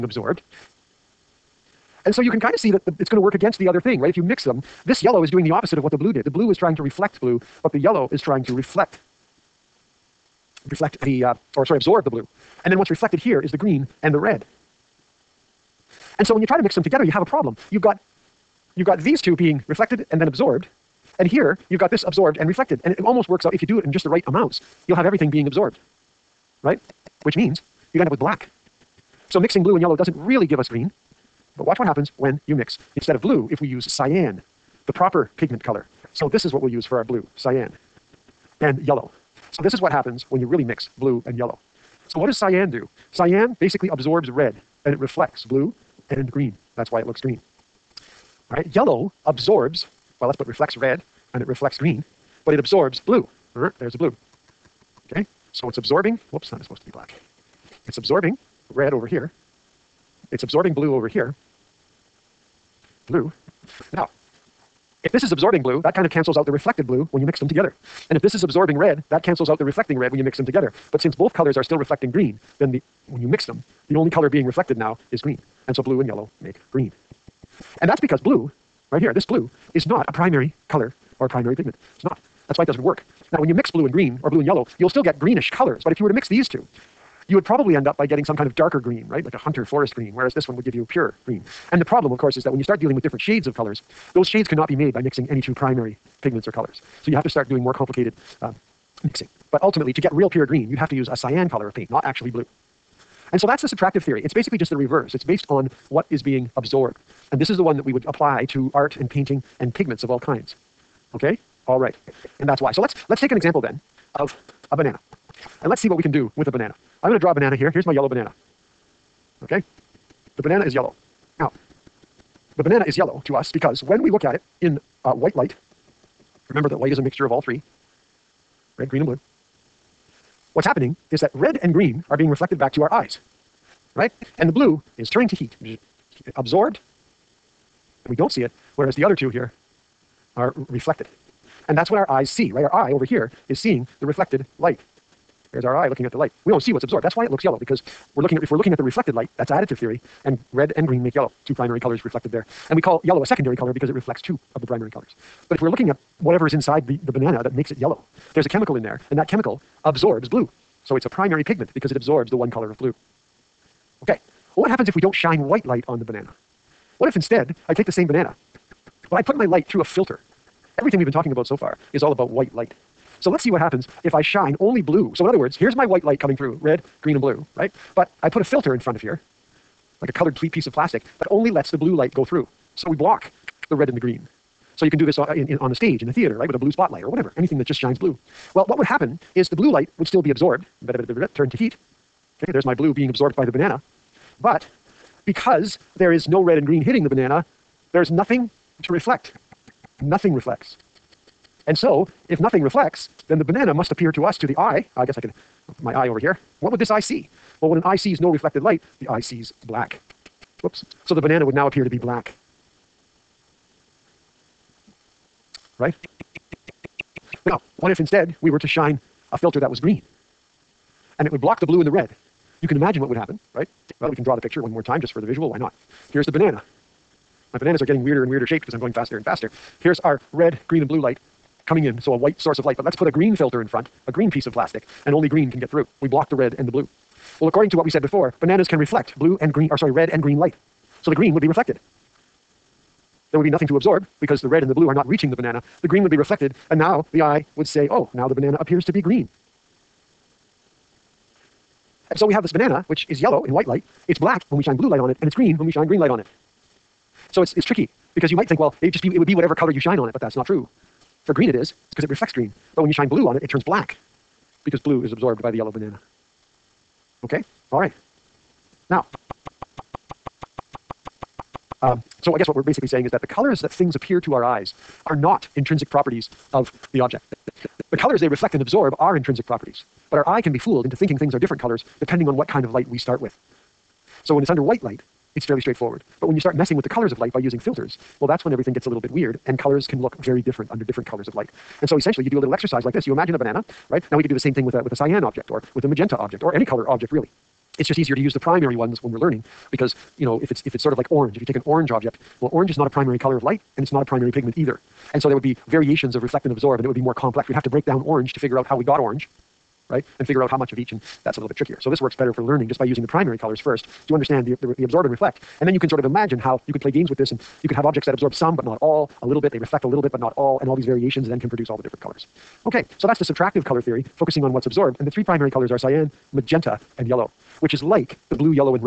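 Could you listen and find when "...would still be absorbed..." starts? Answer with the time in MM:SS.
03:09.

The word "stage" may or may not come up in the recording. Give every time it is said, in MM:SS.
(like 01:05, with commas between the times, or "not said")
03:05.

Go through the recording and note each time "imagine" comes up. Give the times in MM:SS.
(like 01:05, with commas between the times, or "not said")
03:42, 04:53, 05:16.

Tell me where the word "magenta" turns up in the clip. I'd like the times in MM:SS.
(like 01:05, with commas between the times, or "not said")
04:55, 05:26.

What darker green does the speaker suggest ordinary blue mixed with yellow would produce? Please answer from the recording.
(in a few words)
Hunter forest green.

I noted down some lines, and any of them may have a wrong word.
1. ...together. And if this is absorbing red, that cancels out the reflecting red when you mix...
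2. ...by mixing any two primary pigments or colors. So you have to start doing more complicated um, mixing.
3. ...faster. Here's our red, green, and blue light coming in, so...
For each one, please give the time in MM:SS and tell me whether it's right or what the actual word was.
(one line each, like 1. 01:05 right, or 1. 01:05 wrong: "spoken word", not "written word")
1. 01:07 right
2. 01:34 right
3. 03:49 right.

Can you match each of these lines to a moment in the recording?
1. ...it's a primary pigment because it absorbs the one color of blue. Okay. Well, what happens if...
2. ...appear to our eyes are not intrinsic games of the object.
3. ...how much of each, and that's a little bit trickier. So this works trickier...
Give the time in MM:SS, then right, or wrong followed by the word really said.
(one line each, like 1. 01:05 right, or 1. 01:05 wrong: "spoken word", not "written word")
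1. 02:40 right
2. 04:33 wrong: "properties", not "games"
3. 05:10 wrong: "better", not "trickier".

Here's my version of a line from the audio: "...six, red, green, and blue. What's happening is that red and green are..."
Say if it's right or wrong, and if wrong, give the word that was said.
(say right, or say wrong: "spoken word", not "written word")
wrong: "three", not "six".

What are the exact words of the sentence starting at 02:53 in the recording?
So let's see what happens if I shine only blue.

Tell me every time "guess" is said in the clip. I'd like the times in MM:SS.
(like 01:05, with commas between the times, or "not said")
03:25, 04:32.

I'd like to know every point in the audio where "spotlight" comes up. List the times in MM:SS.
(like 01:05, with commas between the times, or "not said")
03:06.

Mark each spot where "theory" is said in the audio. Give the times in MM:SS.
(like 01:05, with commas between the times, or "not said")
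01:44, 02:29, 05:23.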